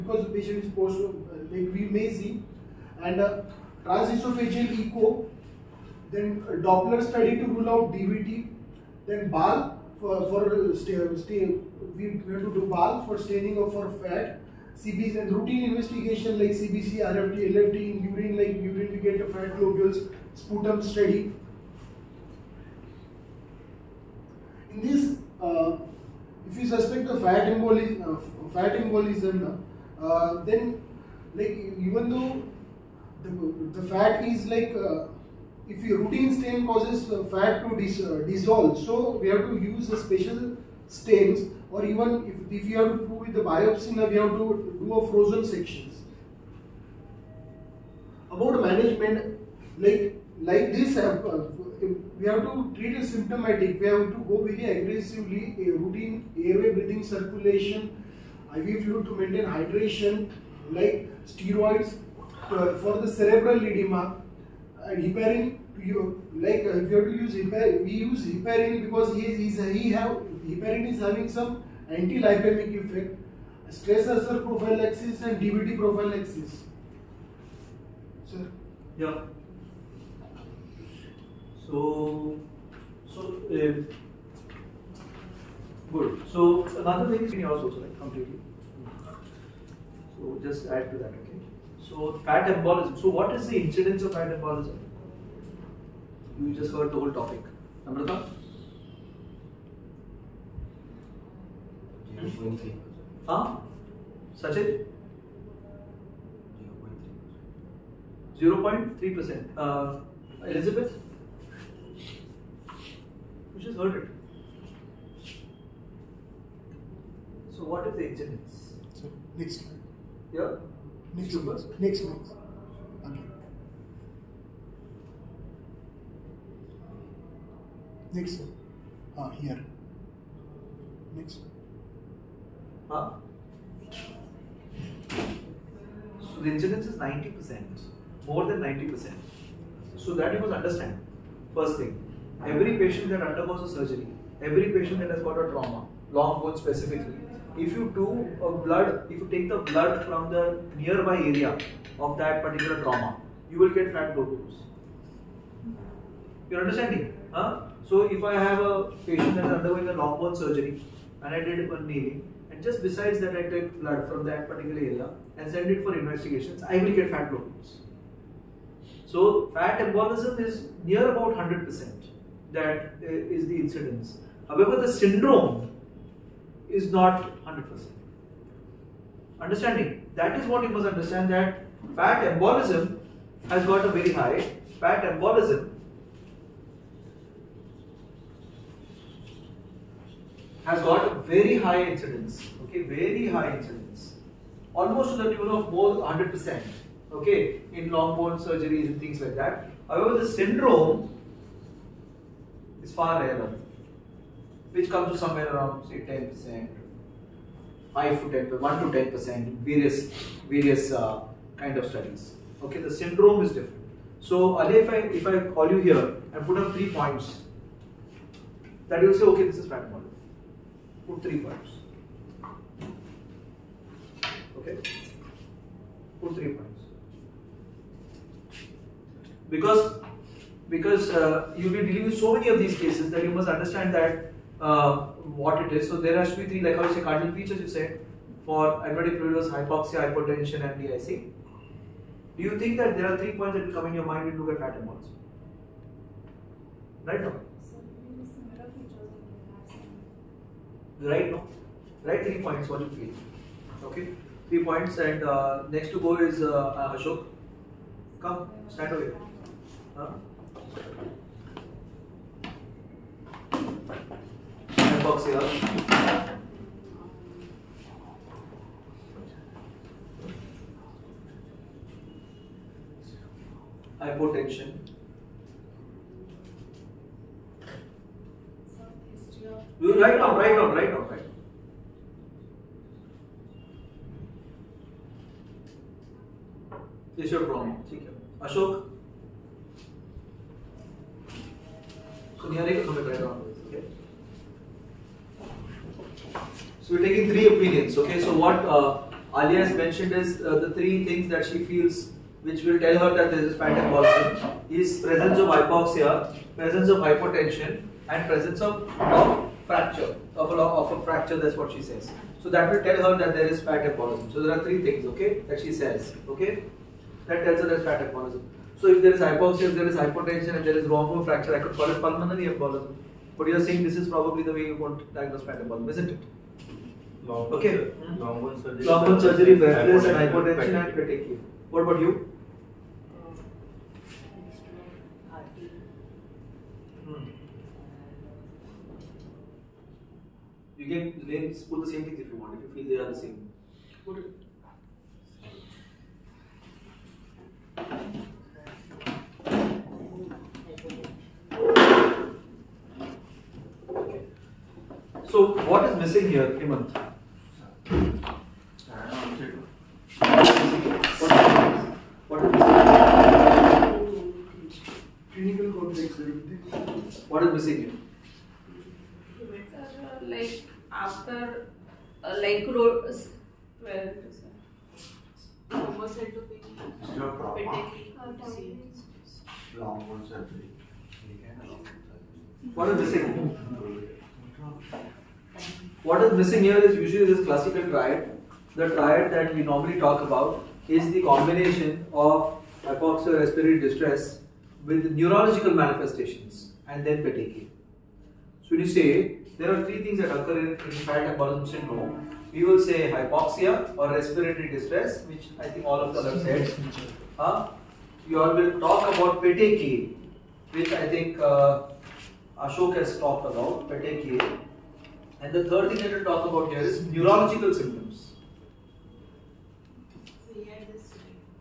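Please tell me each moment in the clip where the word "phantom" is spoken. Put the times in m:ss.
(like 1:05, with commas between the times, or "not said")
5:03, 5:25.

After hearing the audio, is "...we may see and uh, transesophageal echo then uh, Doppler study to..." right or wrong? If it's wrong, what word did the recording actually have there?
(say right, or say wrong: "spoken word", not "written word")
right.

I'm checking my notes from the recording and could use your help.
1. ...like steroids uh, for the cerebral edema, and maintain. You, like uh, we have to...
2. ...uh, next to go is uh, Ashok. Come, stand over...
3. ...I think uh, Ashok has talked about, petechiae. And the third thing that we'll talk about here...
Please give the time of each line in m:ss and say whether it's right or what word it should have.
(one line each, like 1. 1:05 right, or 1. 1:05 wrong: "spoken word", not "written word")
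1. 1:00 wrong: "heparin", not "maintain"
2. 4:15 right
3. 6:50 right.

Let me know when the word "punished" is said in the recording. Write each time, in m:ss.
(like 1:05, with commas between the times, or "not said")
not said.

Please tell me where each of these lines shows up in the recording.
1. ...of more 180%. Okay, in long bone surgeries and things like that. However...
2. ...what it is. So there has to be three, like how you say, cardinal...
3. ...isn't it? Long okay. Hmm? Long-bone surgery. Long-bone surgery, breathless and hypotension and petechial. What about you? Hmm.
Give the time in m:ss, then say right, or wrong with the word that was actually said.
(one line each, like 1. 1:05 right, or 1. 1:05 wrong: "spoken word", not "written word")
1. 3:15 wrong: "100", not "180"
2. 3:55 right
3. 5:25 right.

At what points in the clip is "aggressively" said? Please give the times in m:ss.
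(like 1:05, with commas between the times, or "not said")
0:54.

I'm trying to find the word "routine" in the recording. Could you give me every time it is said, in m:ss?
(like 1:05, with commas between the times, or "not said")
0:15, 0:35, 0:55.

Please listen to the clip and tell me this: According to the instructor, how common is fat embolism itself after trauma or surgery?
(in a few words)
More than 90%.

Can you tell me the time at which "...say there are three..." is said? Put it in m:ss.
6:38.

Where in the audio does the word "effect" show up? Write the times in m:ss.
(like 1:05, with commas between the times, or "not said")
1:12.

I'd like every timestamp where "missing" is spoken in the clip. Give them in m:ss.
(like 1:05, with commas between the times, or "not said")
5:55, 6:26.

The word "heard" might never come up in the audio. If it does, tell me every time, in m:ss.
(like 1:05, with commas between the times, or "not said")
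1:36, 1:53.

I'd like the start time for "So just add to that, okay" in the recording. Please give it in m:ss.
1:30.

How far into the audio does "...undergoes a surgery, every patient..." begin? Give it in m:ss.
2:23.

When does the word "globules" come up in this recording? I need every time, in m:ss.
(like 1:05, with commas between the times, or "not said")
0:19, 2:34, 2:47.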